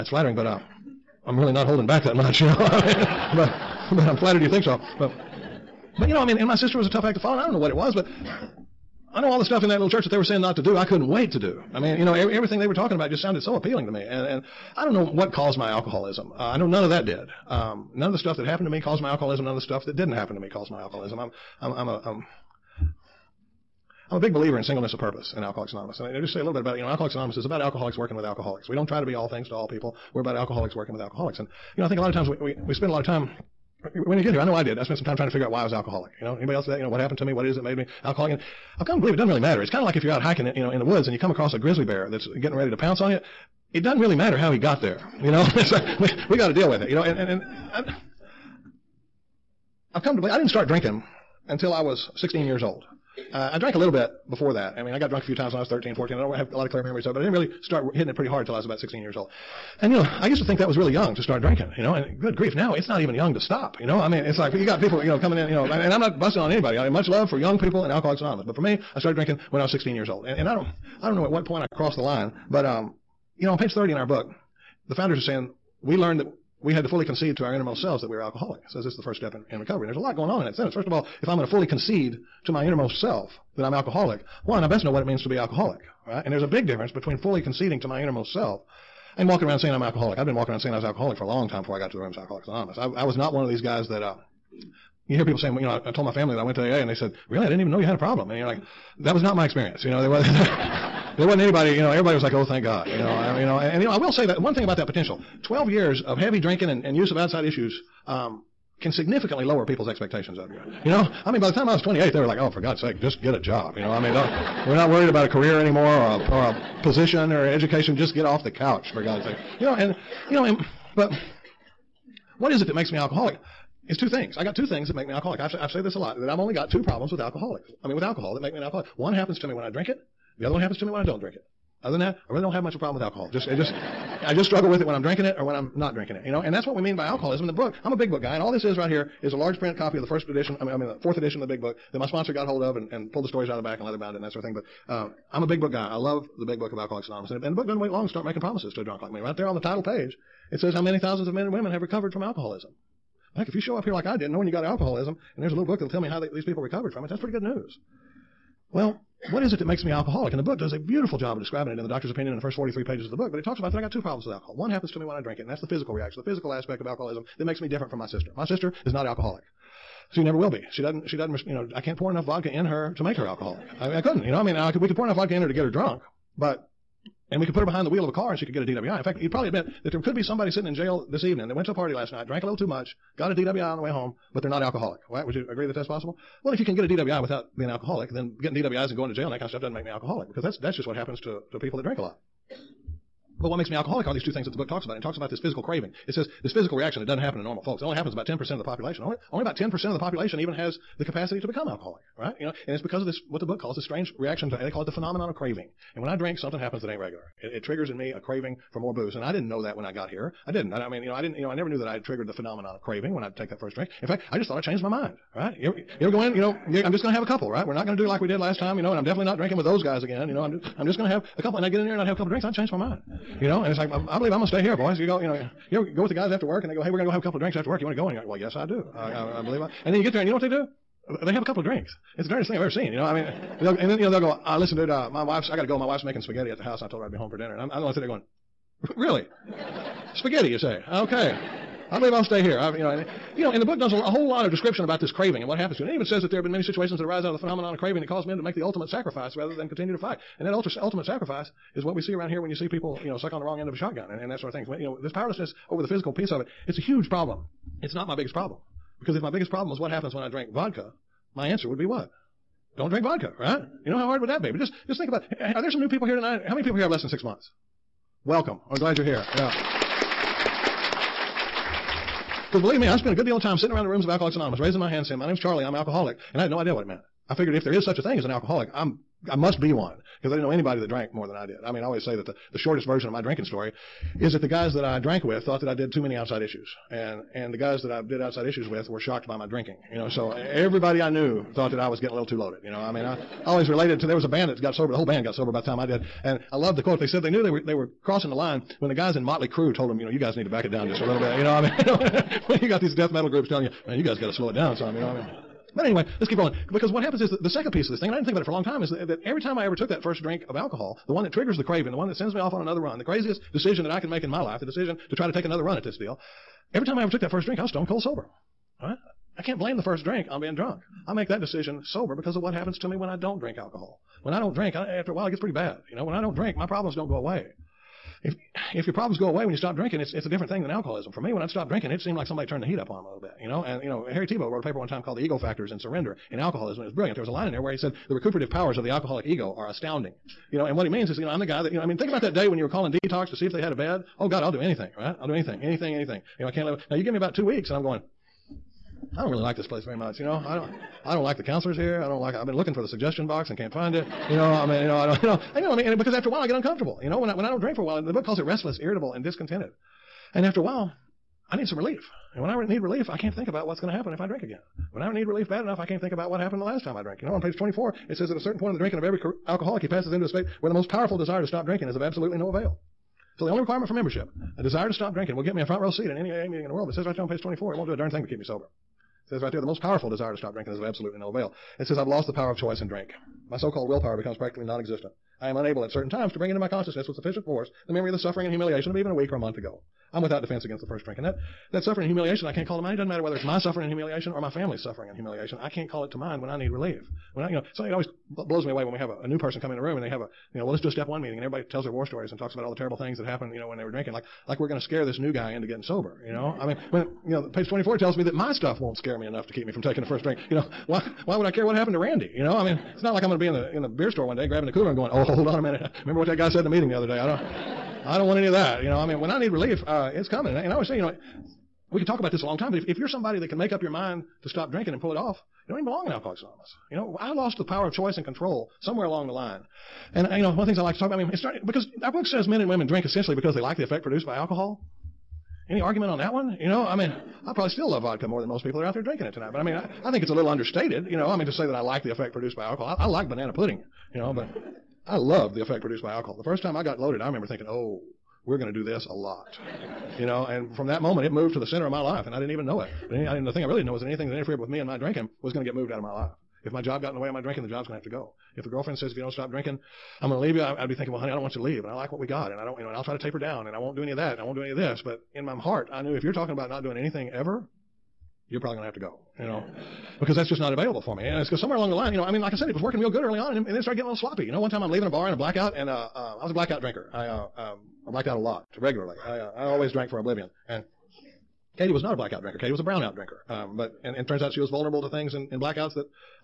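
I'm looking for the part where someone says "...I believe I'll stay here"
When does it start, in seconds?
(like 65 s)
241 s.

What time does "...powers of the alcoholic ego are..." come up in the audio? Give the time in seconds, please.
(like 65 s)
338 s.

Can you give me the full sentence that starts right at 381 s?
It says, I've lost the power of choice in drink.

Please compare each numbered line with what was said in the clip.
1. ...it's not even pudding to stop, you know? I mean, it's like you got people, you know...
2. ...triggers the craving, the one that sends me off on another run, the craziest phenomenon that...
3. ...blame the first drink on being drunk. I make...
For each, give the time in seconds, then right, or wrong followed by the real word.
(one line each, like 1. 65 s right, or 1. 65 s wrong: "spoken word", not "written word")
1. 62 s wrong: "young", not "pudding"
2. 311 s wrong: "decision", not "phenomenon"
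3. 319 s right.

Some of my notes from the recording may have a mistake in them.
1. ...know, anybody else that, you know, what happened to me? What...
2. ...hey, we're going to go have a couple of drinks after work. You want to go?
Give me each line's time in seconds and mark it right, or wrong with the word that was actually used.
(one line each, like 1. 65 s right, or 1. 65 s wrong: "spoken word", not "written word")
1. 36 s right
2. 226 s right.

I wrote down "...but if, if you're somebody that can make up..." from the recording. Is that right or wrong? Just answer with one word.
right.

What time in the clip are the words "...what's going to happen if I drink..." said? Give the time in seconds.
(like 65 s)
363 s.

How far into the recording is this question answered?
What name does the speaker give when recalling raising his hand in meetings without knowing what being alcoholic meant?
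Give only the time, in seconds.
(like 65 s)
275 s.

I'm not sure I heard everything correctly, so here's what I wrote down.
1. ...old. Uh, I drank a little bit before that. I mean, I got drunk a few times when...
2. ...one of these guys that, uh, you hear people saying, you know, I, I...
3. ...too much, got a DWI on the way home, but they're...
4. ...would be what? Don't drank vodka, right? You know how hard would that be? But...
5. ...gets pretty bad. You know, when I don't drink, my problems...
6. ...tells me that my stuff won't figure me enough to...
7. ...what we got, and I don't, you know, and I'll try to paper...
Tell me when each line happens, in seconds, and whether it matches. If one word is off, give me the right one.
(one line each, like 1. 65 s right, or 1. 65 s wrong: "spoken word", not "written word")
1. 52 s right
2. 93 s right
3. 182 s right
4. 261 s wrong: "drink", not "drank"
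5. 325 s right
6. 407 s wrong: "scare", not "figure"
7. 462 s wrong: "taper", not "paper".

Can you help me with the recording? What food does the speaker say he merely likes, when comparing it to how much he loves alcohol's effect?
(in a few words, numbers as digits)
banana pudding.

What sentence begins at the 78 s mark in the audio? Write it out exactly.
Says so this is the first step in, in recovery.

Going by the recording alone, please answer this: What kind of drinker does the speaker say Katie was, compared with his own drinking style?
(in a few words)
brownout drinker.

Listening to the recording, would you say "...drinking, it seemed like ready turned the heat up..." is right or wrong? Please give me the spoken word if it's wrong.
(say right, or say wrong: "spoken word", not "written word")
wrong: "somebody", not "ready".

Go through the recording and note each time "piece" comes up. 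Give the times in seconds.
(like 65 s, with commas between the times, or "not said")
256 s, 307 s.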